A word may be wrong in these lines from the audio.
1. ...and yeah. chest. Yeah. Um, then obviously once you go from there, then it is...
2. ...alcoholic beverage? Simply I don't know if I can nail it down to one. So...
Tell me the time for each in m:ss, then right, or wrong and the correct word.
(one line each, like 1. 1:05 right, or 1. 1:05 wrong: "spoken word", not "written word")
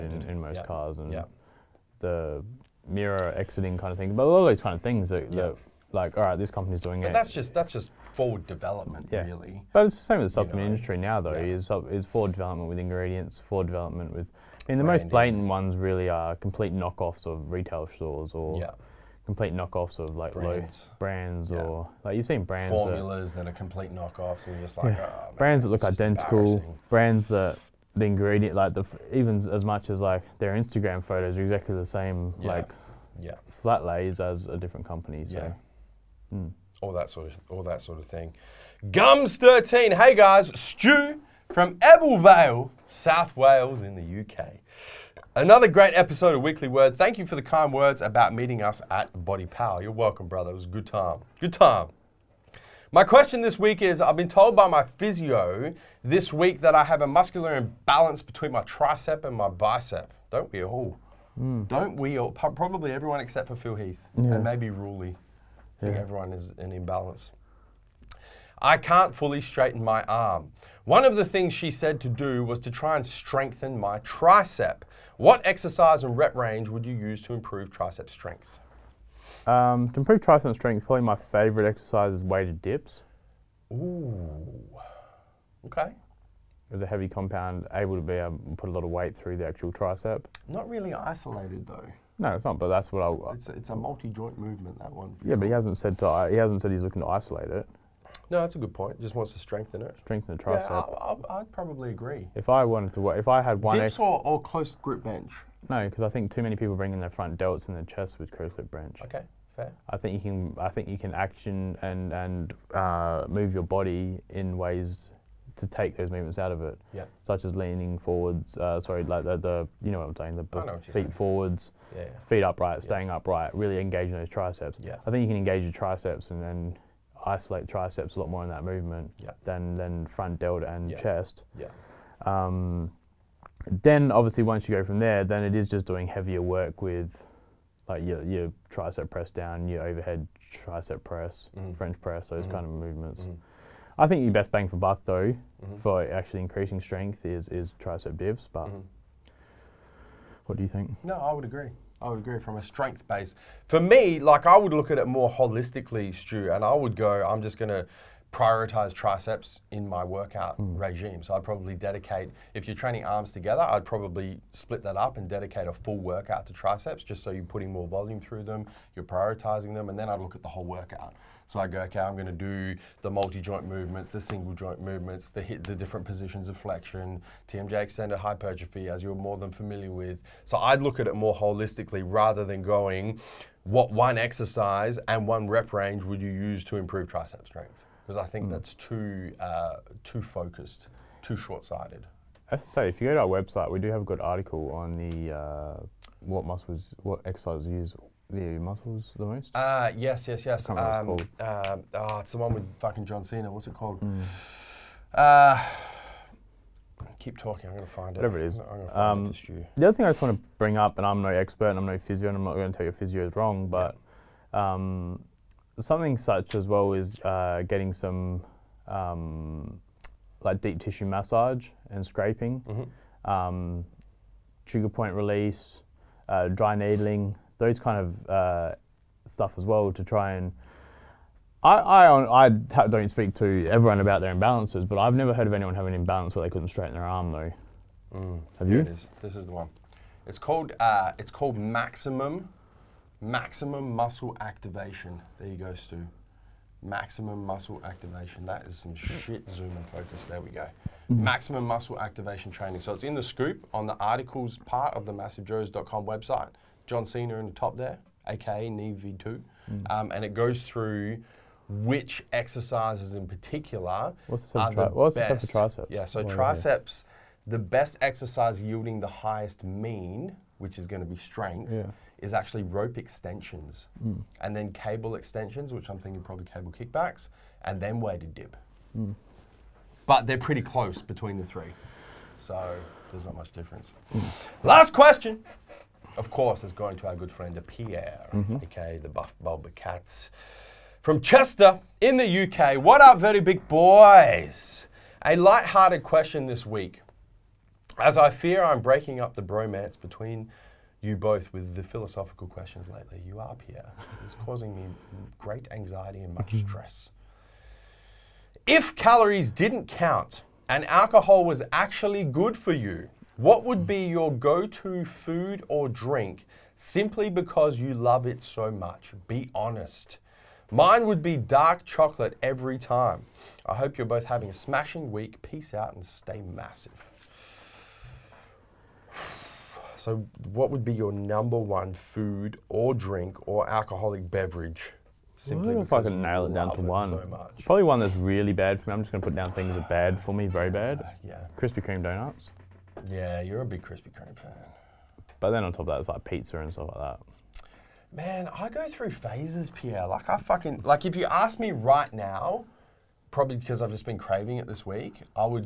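1. 2:10 right
2. 5:33 right.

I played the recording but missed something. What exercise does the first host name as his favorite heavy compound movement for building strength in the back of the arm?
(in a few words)
Weighted dips.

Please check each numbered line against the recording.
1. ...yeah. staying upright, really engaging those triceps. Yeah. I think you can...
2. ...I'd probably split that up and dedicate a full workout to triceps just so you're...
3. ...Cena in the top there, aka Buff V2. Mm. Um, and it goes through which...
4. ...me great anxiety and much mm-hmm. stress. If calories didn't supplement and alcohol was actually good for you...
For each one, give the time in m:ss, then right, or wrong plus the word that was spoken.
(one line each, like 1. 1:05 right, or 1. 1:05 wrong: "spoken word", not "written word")
1. 2:02 right
2. 2:43 right
3. 4:17 wrong: "Neve", not "Buff"
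4. 5:04 wrong: "count", not "supplement".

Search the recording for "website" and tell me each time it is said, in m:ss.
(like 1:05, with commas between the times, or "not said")
3:13, 4:16.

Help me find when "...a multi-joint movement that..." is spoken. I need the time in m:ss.
1:33.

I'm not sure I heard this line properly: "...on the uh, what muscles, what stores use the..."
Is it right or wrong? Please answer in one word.
wrong.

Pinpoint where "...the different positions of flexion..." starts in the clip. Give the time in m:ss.
2:55.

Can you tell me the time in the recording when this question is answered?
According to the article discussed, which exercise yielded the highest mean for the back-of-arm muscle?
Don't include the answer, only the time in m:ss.
4:32.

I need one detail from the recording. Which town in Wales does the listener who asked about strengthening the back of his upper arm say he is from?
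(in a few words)
Ebbw Vale.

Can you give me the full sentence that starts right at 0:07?
That's just that's just forward development, yeah.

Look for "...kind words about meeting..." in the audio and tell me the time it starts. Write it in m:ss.
0:47.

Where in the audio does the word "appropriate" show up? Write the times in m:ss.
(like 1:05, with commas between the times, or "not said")
not said.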